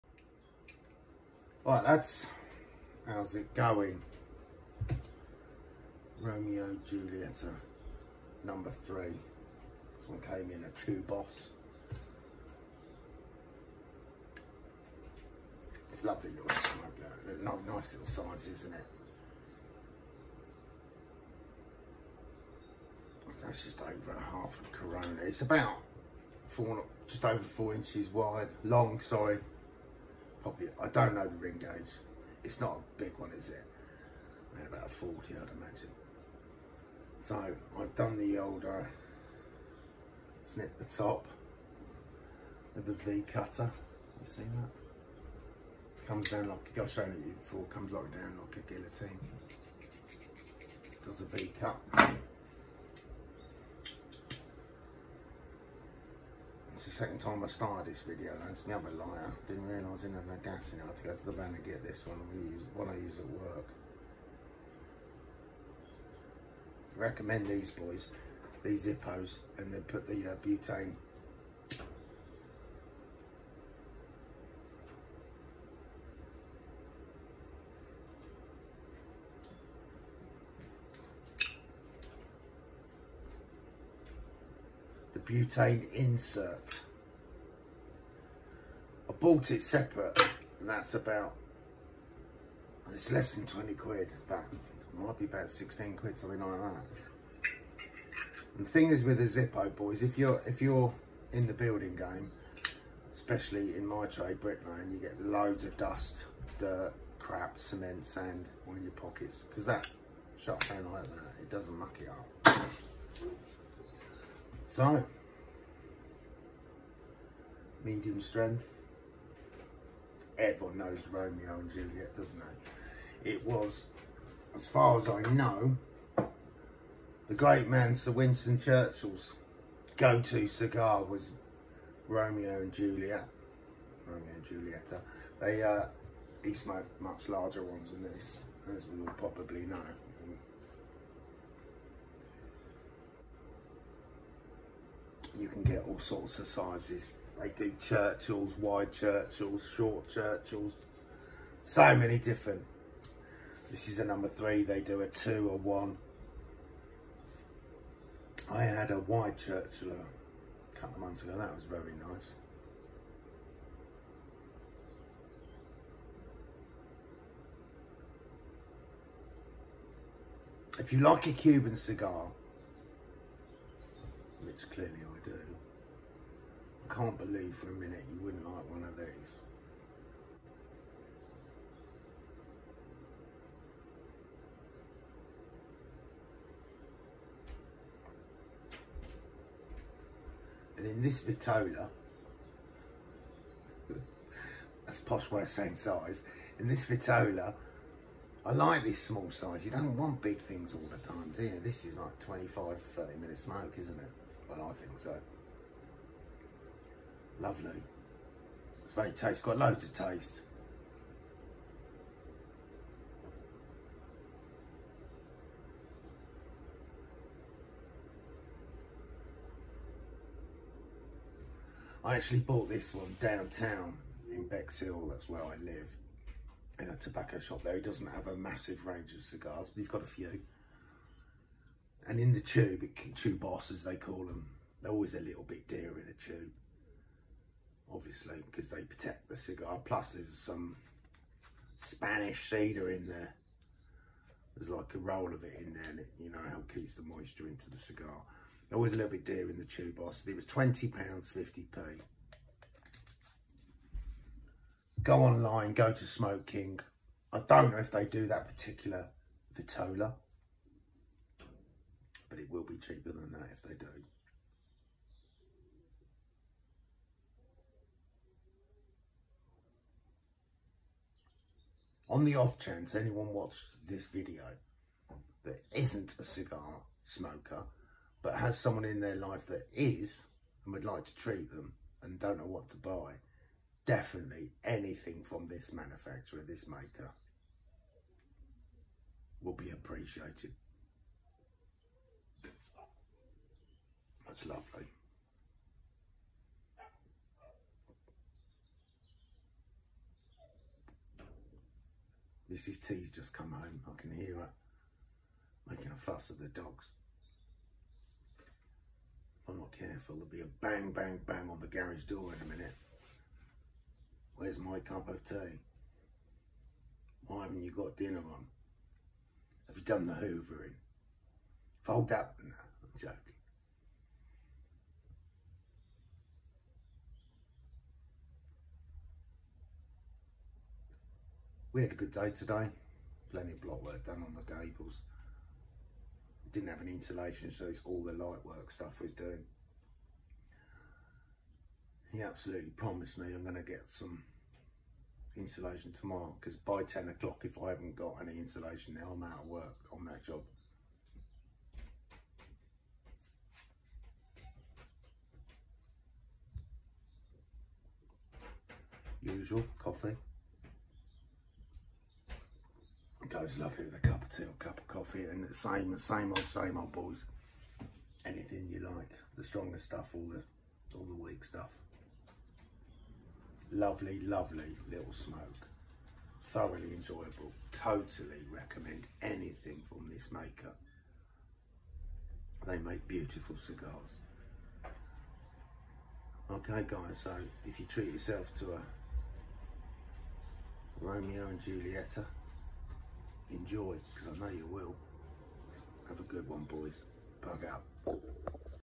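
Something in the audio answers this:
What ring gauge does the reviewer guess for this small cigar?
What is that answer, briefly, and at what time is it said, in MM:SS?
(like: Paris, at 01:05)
40, at 00:34.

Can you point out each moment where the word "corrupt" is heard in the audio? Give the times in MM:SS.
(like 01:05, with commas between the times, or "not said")
not said.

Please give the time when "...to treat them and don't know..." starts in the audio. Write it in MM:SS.
04:41.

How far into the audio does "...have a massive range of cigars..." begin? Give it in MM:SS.
03:48.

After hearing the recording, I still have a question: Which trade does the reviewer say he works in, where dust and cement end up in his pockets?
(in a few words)
Bricklaying.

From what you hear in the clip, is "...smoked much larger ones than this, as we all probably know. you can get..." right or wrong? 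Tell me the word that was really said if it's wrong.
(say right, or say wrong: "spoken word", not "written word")
right.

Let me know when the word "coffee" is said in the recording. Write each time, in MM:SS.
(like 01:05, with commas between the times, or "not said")
05:59, 06:04.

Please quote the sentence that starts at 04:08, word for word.
It was a little bit dear in the tubos.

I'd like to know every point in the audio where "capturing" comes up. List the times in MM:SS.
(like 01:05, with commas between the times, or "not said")
not said.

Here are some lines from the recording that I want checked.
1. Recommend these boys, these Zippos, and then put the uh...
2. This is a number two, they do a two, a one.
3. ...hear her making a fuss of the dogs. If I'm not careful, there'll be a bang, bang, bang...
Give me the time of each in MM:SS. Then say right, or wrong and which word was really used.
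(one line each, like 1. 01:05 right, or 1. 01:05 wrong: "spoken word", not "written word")
1. 01:06 right
2. 02:33 wrong: "three", not "two"
3. 05:04 right.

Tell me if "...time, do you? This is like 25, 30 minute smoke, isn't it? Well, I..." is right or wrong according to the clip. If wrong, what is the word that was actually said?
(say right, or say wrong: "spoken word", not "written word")
right.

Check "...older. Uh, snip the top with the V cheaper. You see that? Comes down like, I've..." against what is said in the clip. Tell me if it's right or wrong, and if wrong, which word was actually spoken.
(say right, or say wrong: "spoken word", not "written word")
wrong: "cutter", not "cheaper".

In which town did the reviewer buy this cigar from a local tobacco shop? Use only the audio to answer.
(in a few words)
Bexhill.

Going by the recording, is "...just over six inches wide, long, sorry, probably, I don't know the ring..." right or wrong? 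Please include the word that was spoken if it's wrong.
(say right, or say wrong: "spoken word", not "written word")
wrong: "four", not "six".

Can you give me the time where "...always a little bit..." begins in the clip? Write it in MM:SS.
03:54.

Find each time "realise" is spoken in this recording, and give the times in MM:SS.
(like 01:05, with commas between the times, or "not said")
00:59.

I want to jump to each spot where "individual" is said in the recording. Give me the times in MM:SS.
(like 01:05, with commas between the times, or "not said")
not said.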